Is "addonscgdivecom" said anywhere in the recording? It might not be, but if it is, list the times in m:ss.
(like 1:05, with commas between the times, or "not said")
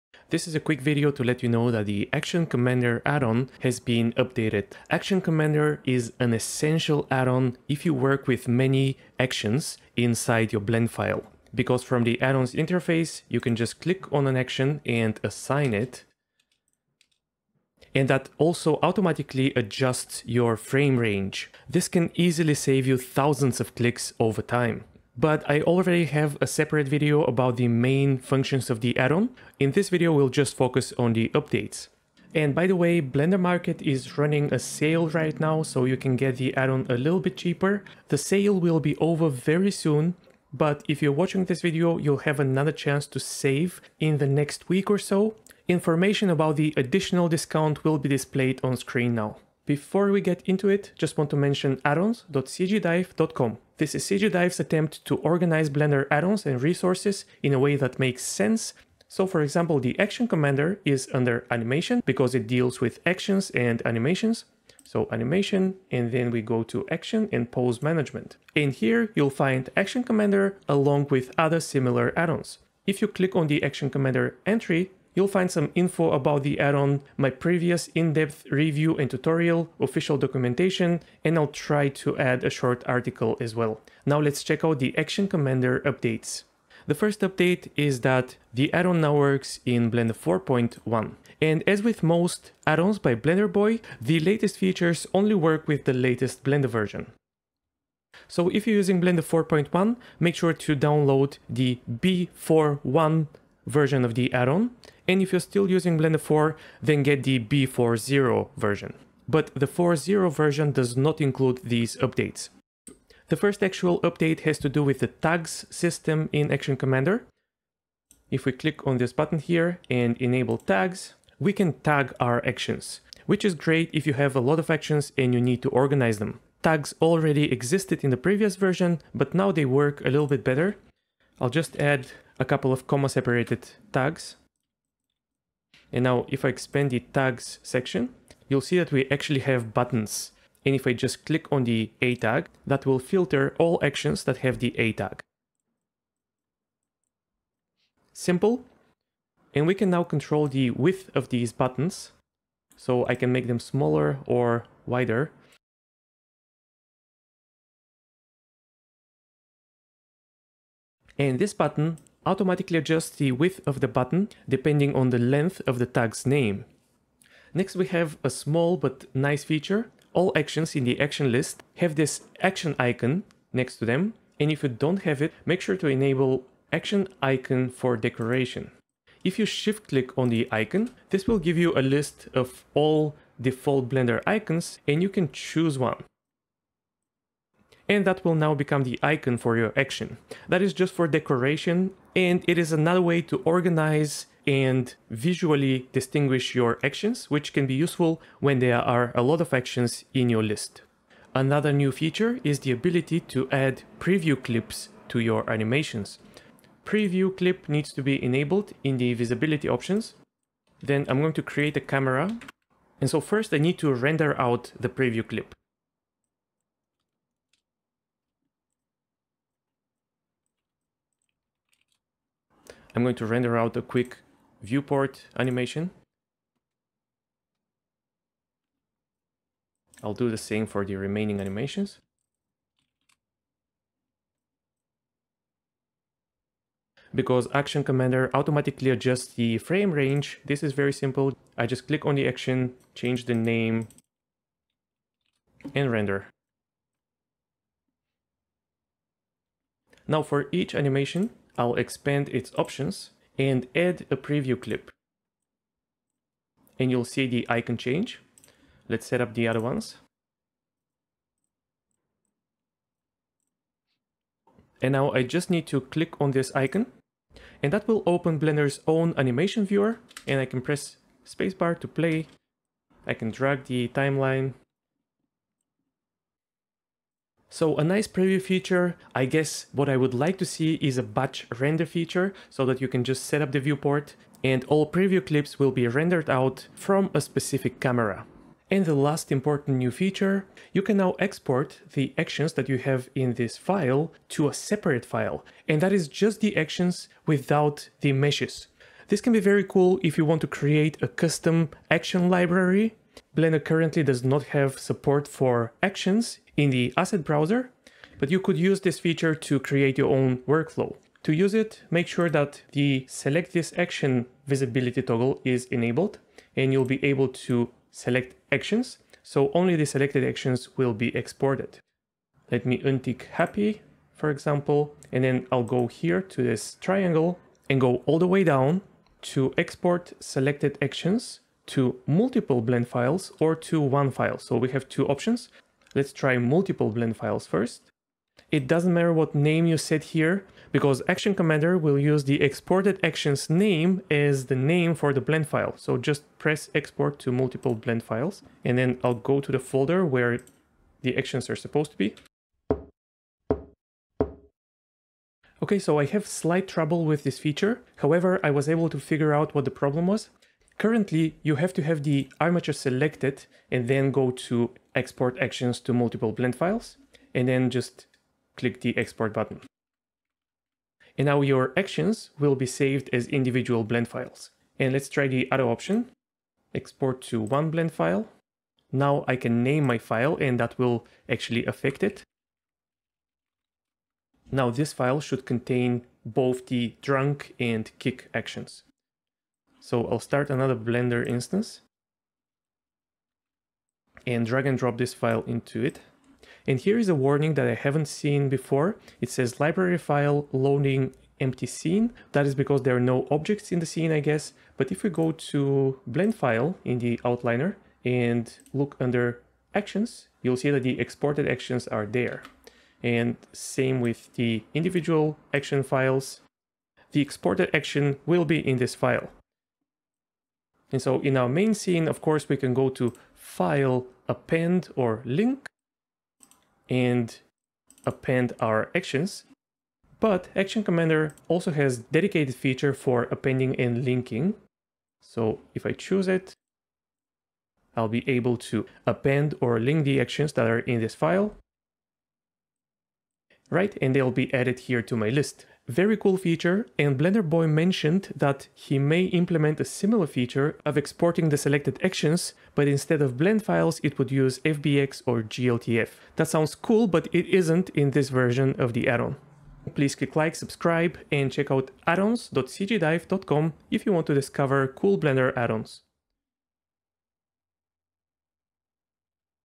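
0:51, 7:42.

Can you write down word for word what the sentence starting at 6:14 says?
And let's try the other option, export to one blend file.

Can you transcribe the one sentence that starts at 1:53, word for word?
The first actual update has to do with the tags system in Action Commander.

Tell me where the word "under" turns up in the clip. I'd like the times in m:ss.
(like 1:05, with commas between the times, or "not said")
1:01, 6:48.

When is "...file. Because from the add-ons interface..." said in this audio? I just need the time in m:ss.
0:10.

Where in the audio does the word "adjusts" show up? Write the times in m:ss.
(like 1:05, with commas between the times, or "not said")
0:19, 2:42, 3:58.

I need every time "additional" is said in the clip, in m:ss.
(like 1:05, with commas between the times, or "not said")
0:46.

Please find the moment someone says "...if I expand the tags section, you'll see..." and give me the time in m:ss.
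2:16.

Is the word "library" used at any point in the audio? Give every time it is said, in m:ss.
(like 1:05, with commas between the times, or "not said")
5:02, 6:39.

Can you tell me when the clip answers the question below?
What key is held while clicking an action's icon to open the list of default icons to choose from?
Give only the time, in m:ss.
2:59.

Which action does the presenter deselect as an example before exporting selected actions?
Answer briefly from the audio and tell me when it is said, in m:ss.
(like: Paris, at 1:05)
happy, at 5:23.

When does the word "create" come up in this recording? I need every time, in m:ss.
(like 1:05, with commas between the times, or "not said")
3:31, 5:00, 5:09.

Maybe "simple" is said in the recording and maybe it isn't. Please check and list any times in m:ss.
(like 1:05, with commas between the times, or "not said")
2:28, 4:00.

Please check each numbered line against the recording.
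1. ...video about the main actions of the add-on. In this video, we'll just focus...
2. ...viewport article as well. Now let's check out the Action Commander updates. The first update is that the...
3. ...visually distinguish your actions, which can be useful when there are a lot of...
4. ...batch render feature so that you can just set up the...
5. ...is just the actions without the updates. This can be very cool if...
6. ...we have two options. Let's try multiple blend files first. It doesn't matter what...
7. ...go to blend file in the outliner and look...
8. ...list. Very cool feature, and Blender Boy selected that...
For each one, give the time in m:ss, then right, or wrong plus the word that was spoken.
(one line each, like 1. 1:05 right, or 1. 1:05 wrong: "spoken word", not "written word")
1. 0:26 wrong: "functions", not "actions"
2. 1:22 wrong: "short", not "viewport"
3. 3:15 right
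4. 4:41 right
5. 4:55 wrong: "meshes", not "updates"
6. 5:34 right
7. 6:45 right
8. 7:25 wrong: "mentioned", not "selected".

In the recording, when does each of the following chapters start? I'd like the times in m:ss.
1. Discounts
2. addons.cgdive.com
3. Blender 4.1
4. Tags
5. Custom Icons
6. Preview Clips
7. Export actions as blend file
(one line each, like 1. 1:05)
1. 0:35
2. 0:50
3. 1:25
4. 1:55
5. 2:49
6. 3:25
7. 4:47.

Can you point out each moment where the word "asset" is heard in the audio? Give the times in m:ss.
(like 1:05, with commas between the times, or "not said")
5:06.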